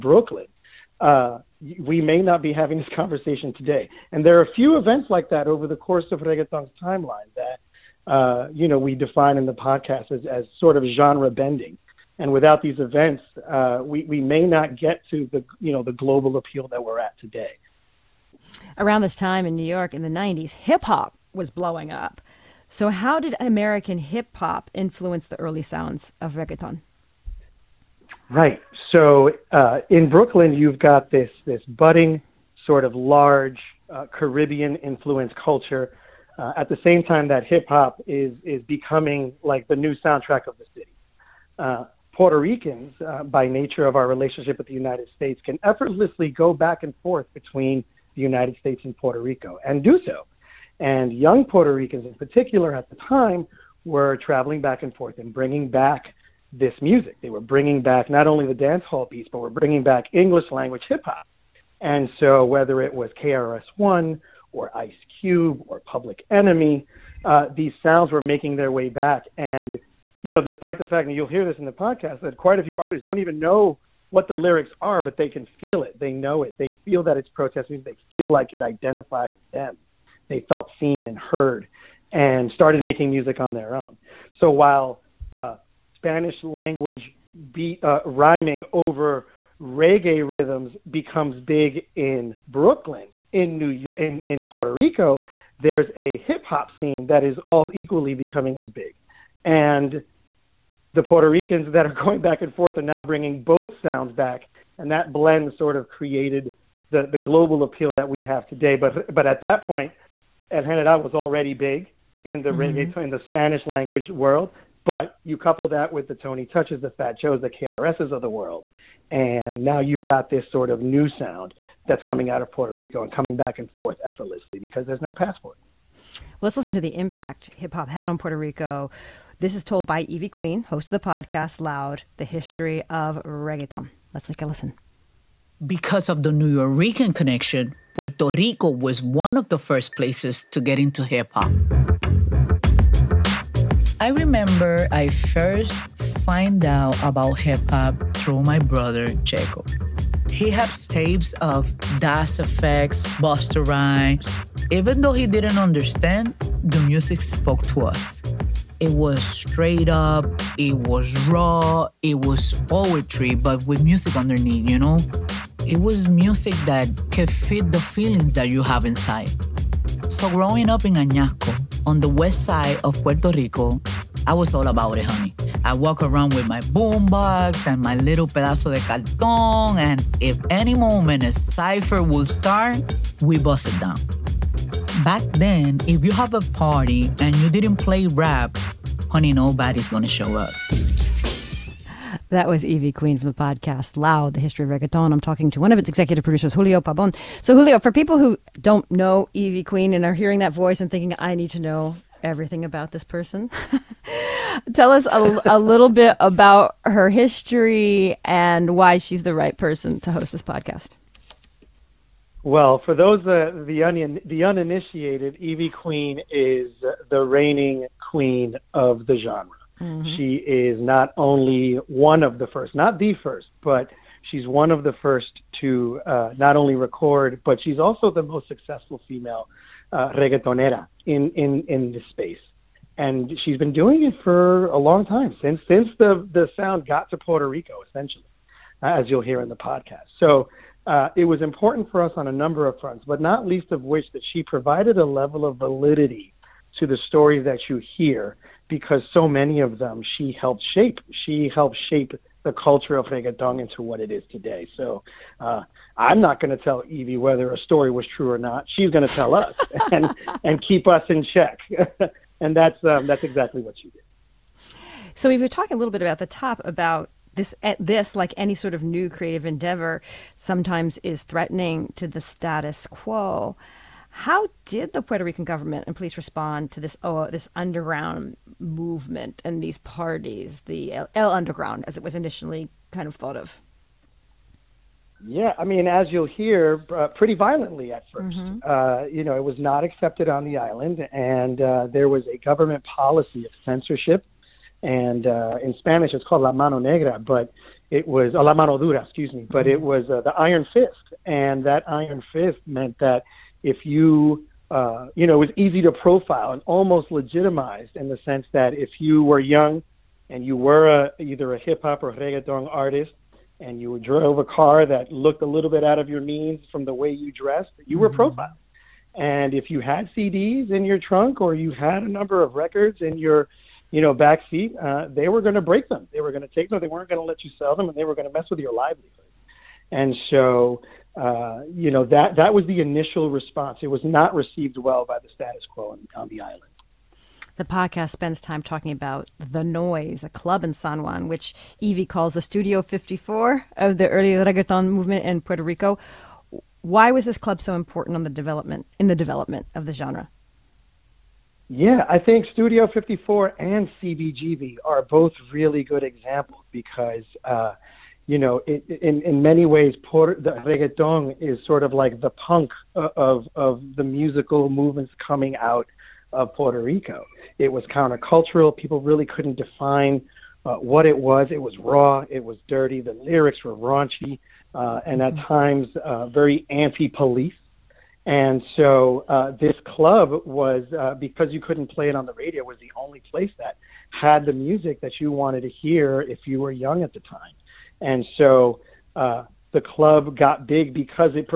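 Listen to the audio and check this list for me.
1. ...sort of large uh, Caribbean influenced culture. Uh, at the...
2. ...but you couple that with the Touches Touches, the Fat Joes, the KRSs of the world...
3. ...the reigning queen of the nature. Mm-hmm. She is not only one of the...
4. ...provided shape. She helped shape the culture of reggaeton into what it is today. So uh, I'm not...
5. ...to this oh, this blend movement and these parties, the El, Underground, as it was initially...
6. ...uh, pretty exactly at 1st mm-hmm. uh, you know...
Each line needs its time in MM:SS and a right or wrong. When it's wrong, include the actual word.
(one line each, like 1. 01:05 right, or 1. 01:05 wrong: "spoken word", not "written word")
1. 00:32 right
2. 01:54 wrong: "Tony", not "Touches"
3. 03:37 wrong: "genre", not "nature"
4. 04:10 wrong: "helped", not "provided"
5. 04:36 wrong: "underground", not "blend"
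6. 04:46 wrong: "violently", not "exactly".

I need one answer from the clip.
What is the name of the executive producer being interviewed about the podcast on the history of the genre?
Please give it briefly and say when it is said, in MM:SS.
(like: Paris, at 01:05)
Julio Pabon, at 03:16.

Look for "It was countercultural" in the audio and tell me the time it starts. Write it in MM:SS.
06:07.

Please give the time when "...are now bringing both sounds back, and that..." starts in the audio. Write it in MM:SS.
01:42.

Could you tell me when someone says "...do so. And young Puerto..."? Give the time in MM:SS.
00:49.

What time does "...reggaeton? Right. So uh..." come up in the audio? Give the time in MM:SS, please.
00:26.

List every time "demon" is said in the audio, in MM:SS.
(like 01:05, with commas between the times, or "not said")
not said.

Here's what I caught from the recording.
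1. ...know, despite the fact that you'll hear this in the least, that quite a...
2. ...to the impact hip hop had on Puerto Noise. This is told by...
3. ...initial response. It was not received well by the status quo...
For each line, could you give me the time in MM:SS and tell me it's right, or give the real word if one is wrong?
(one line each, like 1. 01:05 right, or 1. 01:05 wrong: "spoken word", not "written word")
1. 01:10 wrong: "podcast", not "least"
2. 02:06 wrong: "Rico", not "Noise"
3. 05:32 right.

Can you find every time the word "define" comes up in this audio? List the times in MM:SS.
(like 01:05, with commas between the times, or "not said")
00:08, 06:09.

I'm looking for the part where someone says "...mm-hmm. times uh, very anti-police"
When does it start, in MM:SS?
06:15.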